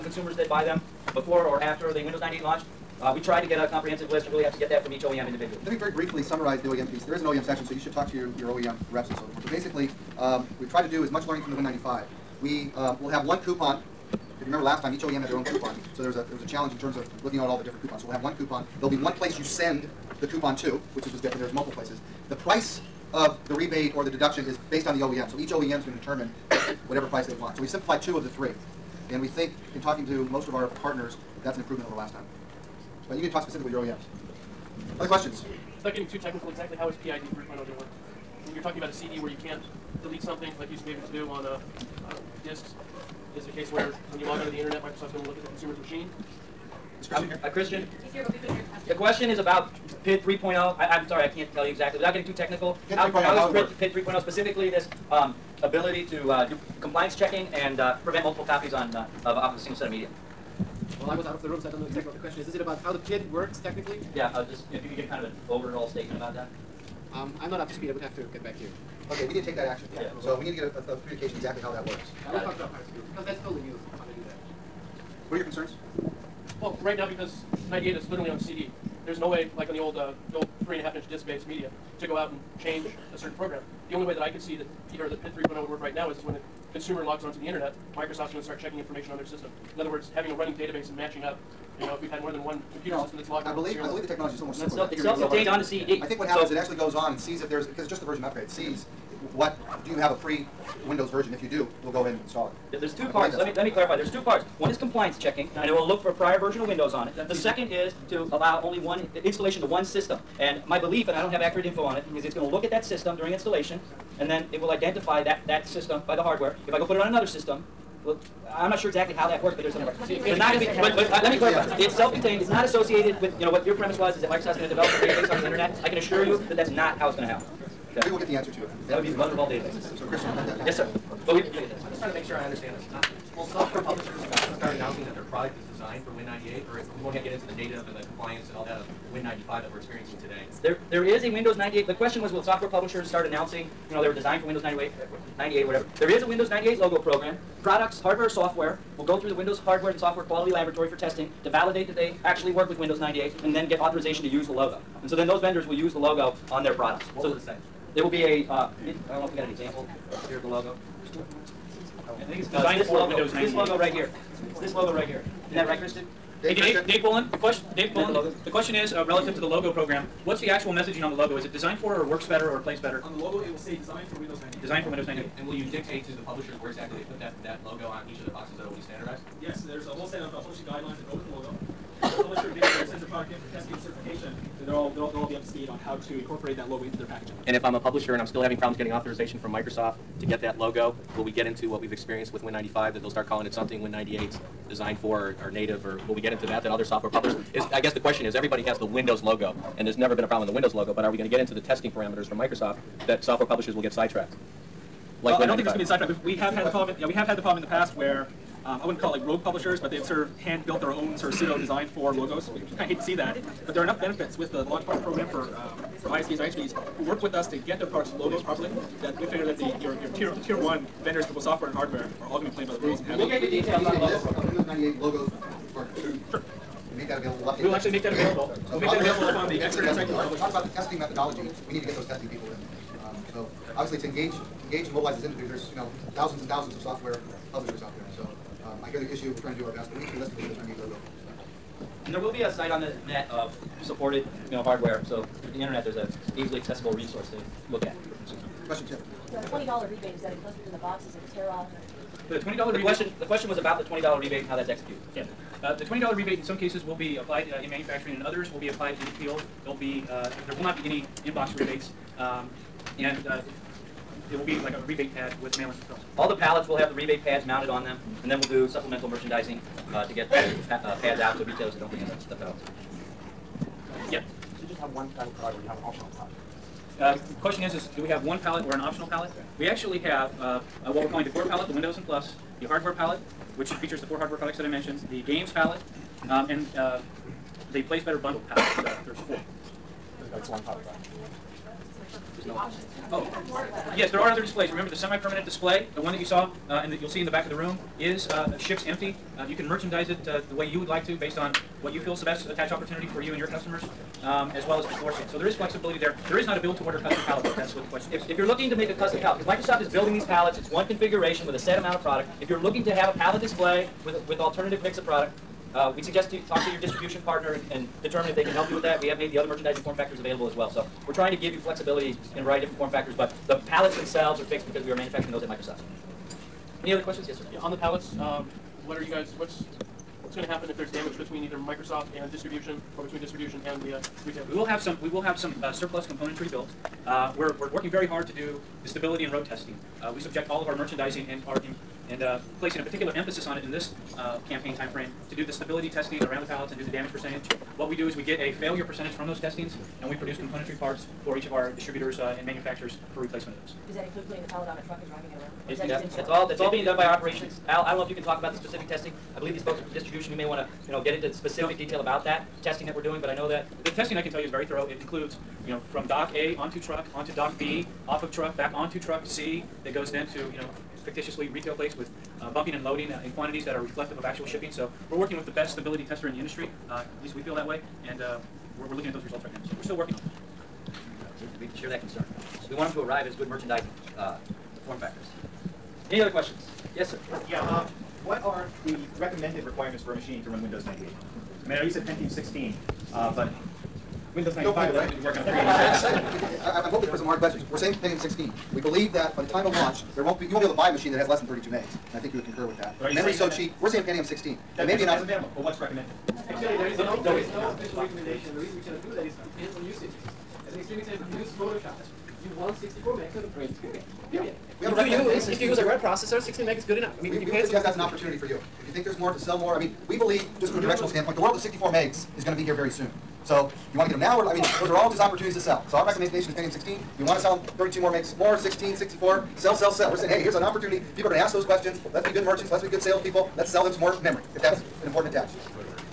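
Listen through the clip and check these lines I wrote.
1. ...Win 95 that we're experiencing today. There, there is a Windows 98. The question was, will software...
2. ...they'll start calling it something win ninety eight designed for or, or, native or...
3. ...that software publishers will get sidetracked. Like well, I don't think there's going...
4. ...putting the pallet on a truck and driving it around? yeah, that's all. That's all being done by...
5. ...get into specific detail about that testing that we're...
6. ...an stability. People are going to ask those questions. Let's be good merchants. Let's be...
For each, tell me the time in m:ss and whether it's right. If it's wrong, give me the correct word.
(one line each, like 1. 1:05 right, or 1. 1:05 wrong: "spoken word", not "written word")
1. 2:19 right
2. 3:13 right
3. 3:23 right
4. 5:54 right
5. 6:01 right
6. 7:10 wrong: "opportunity", not "stability".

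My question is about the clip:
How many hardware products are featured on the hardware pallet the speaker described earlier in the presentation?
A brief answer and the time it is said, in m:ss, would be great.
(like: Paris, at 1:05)
4, at 4:44.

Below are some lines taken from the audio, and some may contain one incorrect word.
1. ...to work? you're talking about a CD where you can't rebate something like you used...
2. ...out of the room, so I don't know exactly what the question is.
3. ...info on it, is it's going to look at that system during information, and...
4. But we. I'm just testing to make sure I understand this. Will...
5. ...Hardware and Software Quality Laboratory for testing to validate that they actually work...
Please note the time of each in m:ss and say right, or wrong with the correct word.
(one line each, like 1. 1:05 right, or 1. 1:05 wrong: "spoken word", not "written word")
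1. 0:37 wrong: "delete", not "rebate"
2. 1:01 right
3. 1:51 wrong: "installation", not "information"
4. 2:11 wrong: "trying", not "testing"
5. 2:29 right.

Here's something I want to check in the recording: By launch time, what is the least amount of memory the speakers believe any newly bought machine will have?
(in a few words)
32 MB.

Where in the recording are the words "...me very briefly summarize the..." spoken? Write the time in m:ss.
0:05.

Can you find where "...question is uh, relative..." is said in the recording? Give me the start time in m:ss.
2:48.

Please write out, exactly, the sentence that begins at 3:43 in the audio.
We'll get the details on the uh, Windows 98 logos for Sure.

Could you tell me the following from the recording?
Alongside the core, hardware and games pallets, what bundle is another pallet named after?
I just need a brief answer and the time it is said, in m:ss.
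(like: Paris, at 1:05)
Plays Better bundle, at 4:47.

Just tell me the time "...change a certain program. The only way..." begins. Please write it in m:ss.
1:22.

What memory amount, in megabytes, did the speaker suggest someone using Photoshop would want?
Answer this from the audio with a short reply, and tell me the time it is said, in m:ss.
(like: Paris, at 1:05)
64 MB, at 6:52.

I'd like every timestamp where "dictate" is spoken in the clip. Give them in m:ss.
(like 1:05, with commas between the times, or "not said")
2:55.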